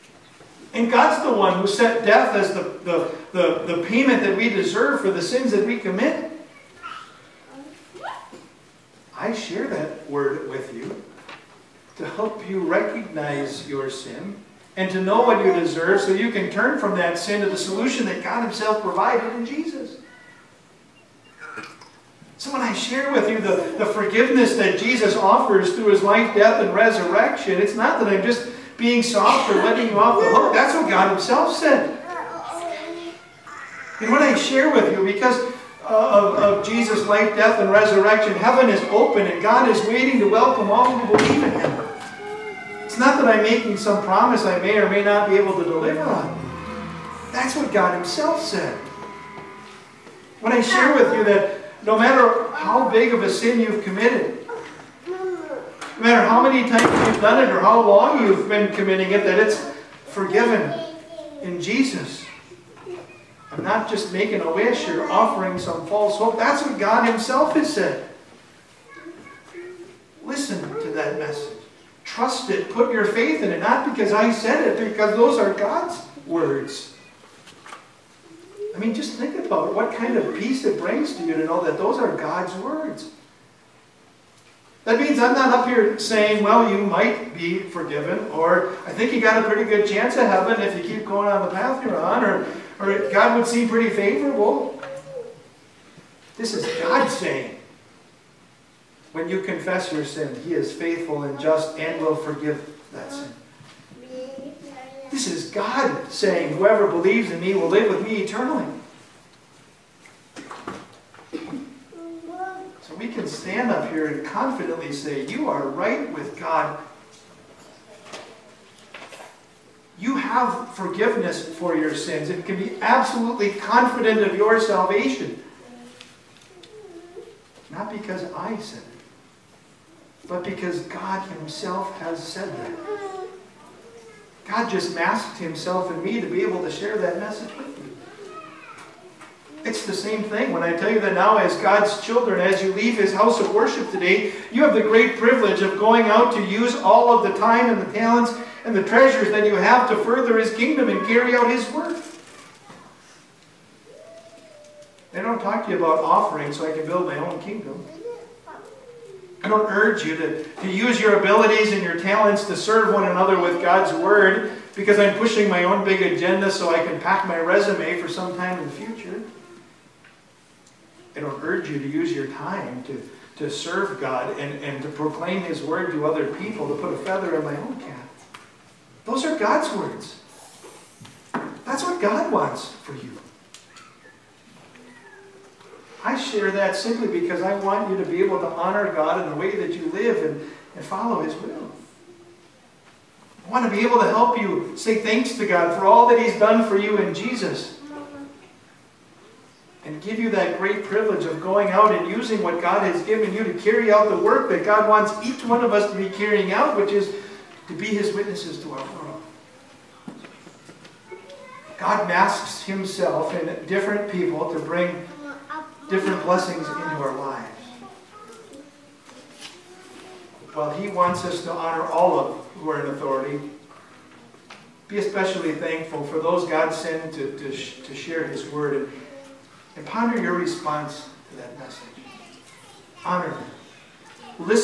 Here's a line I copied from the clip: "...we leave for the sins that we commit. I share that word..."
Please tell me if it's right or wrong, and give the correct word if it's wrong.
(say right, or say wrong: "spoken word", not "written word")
wrong: "deserve", not "leave".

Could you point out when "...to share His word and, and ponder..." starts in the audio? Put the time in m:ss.
3:47.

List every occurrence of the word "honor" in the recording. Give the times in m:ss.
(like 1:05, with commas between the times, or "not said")
3:08, 3:41, 3:53.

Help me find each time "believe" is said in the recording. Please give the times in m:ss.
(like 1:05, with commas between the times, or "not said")
0:41, 1:46.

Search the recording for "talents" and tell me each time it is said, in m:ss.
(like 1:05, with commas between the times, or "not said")
2:27, 2:41.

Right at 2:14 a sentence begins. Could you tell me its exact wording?
God just masked Himself in me to be able to share that message with you.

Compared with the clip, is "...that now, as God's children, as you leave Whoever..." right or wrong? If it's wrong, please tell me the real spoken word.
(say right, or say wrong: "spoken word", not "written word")
wrong: "His", not "Whoever".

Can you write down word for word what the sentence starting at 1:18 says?
I mean, just think about what kind of peace it brings to you to know that those are God's words.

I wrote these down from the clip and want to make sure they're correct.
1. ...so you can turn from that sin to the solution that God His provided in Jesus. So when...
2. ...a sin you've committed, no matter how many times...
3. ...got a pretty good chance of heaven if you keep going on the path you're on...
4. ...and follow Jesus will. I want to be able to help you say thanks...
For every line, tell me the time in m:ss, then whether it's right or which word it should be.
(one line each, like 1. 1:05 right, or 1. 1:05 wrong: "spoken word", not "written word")
1. 0:15 wrong: "Himself", not "His"
2. 0:53 right
3. 1:29 right
4. 3:10 wrong: "His", not "Jesus".